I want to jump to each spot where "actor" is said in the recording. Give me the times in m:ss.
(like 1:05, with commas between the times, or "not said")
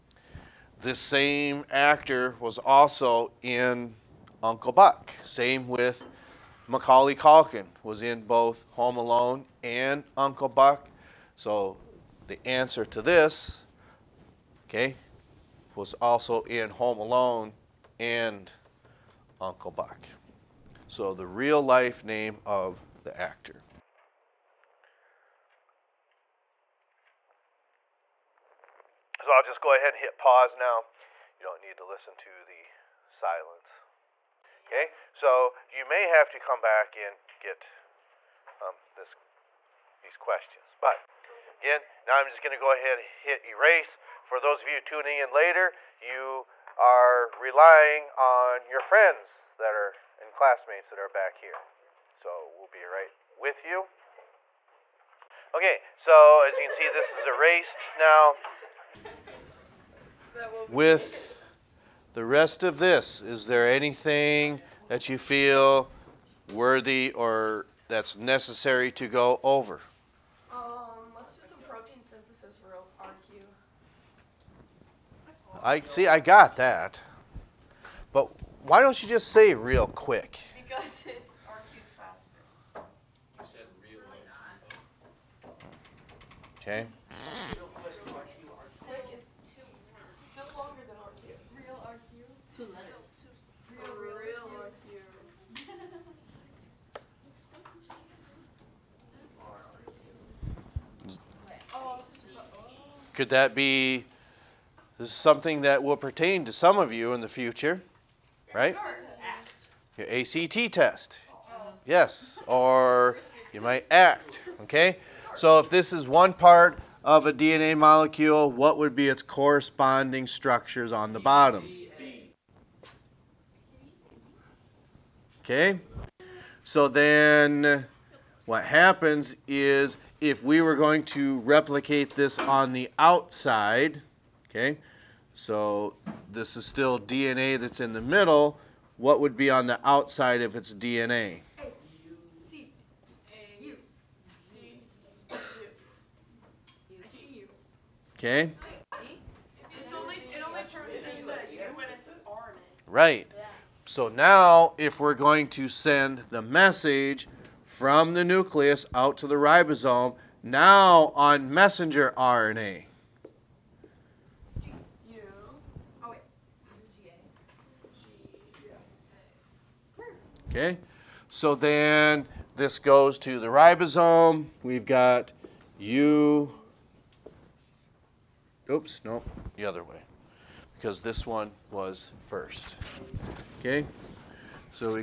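0:01, 0:23.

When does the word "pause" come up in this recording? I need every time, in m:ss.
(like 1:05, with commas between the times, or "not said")
0:30.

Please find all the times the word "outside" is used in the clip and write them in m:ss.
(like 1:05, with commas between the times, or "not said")
2:12, 2:19.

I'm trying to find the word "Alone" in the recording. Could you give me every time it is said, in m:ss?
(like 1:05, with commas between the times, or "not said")
0:08, 0:16.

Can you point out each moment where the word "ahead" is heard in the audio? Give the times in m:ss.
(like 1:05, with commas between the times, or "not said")
0:29, 0:42.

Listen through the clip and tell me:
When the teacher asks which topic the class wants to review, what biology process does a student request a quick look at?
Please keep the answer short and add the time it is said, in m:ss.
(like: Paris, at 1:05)
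Protein synthesis, at 1:11.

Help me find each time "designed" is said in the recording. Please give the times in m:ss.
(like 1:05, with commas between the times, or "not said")
not said.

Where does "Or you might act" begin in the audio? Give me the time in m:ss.
1:52.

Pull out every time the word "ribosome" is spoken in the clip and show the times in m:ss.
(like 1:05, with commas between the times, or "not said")
2:39, 2:53.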